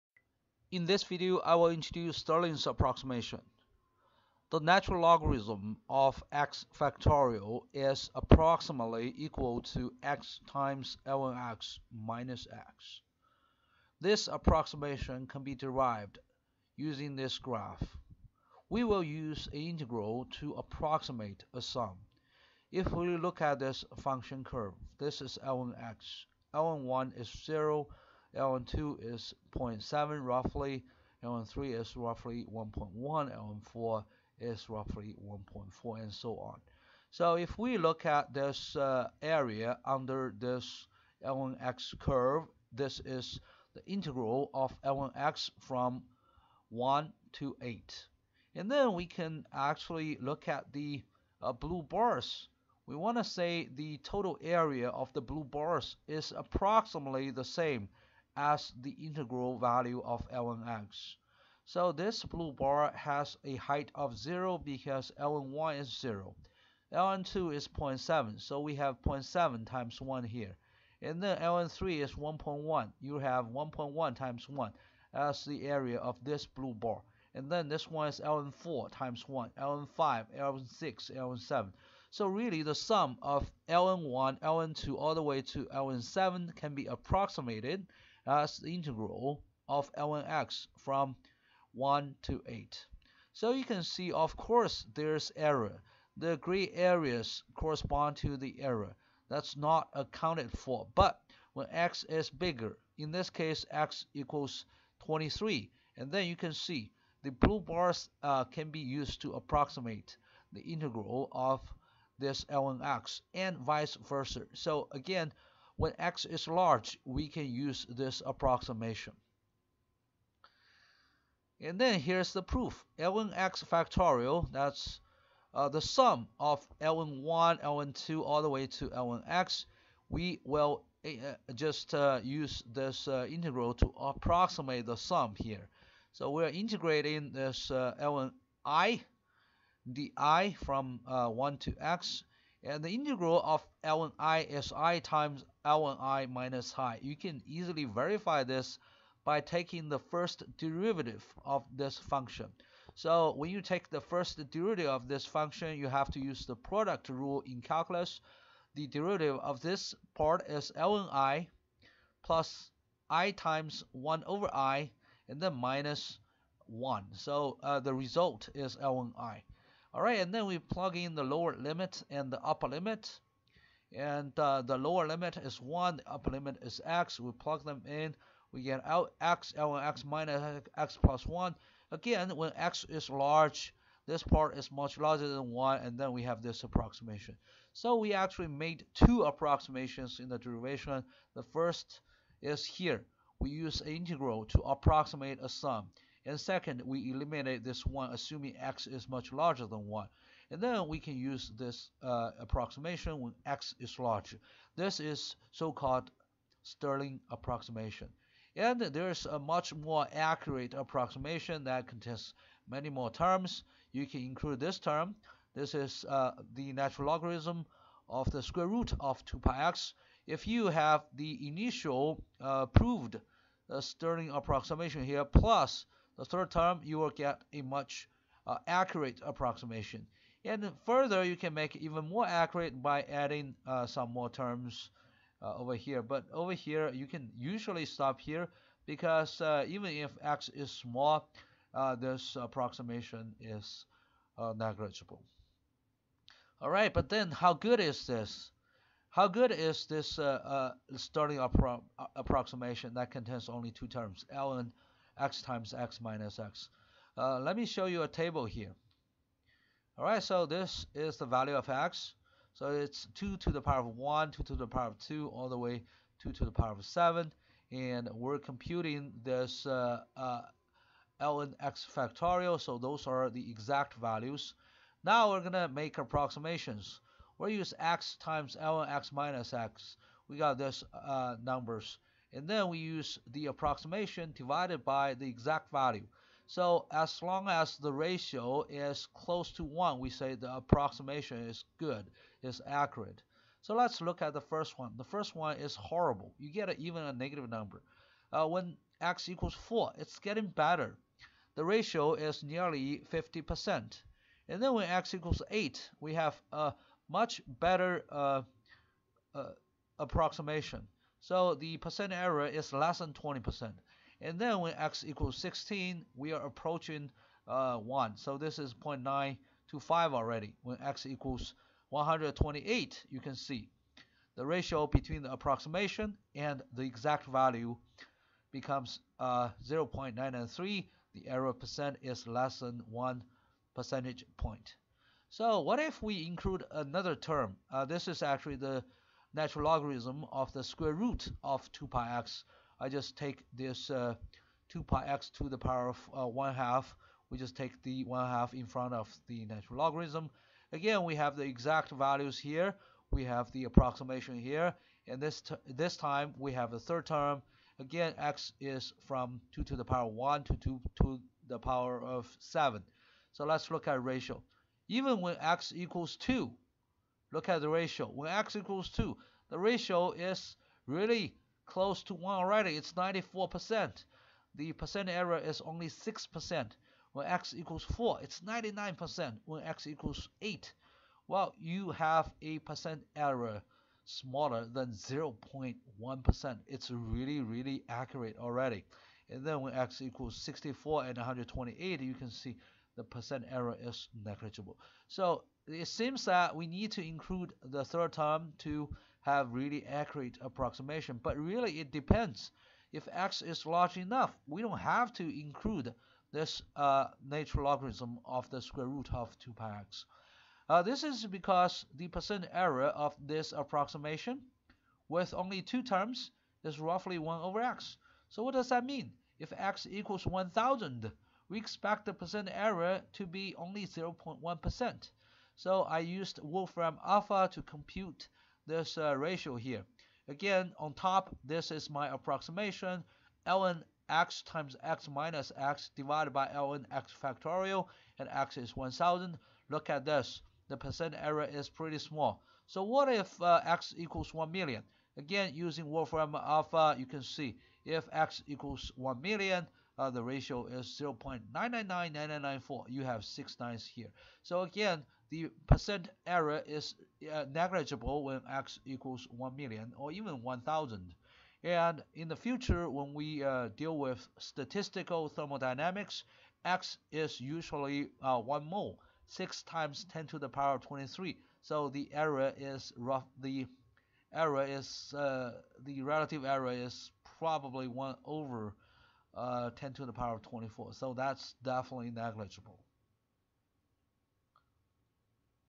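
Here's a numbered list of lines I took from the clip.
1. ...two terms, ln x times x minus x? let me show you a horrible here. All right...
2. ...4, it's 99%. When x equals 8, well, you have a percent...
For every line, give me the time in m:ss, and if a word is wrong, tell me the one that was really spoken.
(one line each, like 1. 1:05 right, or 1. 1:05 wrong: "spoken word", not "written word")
1. 4:13 wrong: "table", not "horrible"
2. 6:17 right.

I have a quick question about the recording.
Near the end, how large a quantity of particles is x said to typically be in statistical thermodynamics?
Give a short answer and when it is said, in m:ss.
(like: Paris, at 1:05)
1 mole, at 7:48.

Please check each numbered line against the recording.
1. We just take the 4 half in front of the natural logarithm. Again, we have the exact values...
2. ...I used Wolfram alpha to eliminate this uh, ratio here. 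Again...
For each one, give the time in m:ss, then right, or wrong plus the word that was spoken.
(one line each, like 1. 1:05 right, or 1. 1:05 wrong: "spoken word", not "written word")
1. 5:47 wrong: "1", not "4"
2. 7:05 wrong: "compute", not "eliminate".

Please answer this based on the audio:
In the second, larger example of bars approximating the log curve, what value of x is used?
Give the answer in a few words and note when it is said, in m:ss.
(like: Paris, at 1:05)
23, at 1:43.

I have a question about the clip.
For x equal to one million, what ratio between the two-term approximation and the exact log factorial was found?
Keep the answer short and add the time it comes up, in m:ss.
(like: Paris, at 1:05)
0.999994, at 7:31.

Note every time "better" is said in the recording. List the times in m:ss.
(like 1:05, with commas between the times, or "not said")
5:00, 5:07.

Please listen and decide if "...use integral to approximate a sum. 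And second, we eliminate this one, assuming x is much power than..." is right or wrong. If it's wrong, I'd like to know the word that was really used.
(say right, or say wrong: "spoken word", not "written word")
wrong: "larger", not "power".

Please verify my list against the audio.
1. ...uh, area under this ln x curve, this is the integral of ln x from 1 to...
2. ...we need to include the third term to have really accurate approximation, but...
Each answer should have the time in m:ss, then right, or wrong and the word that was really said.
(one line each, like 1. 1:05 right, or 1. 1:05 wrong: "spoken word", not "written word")
1. 0:38 right
2. 6:36 right.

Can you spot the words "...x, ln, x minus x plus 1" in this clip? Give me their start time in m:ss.
2:59.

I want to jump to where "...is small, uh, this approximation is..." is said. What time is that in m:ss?
4:00.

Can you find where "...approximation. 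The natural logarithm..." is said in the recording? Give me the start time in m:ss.
0:02.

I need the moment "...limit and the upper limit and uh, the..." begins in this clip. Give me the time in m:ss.
2:51.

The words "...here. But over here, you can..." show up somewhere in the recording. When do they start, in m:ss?
3:55.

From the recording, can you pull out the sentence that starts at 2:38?
The derivative of this part is ln i plus i times 1 over i and then minus 1.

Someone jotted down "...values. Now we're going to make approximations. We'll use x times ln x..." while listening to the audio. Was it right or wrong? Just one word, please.
right.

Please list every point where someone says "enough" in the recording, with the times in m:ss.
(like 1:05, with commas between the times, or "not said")
6:43.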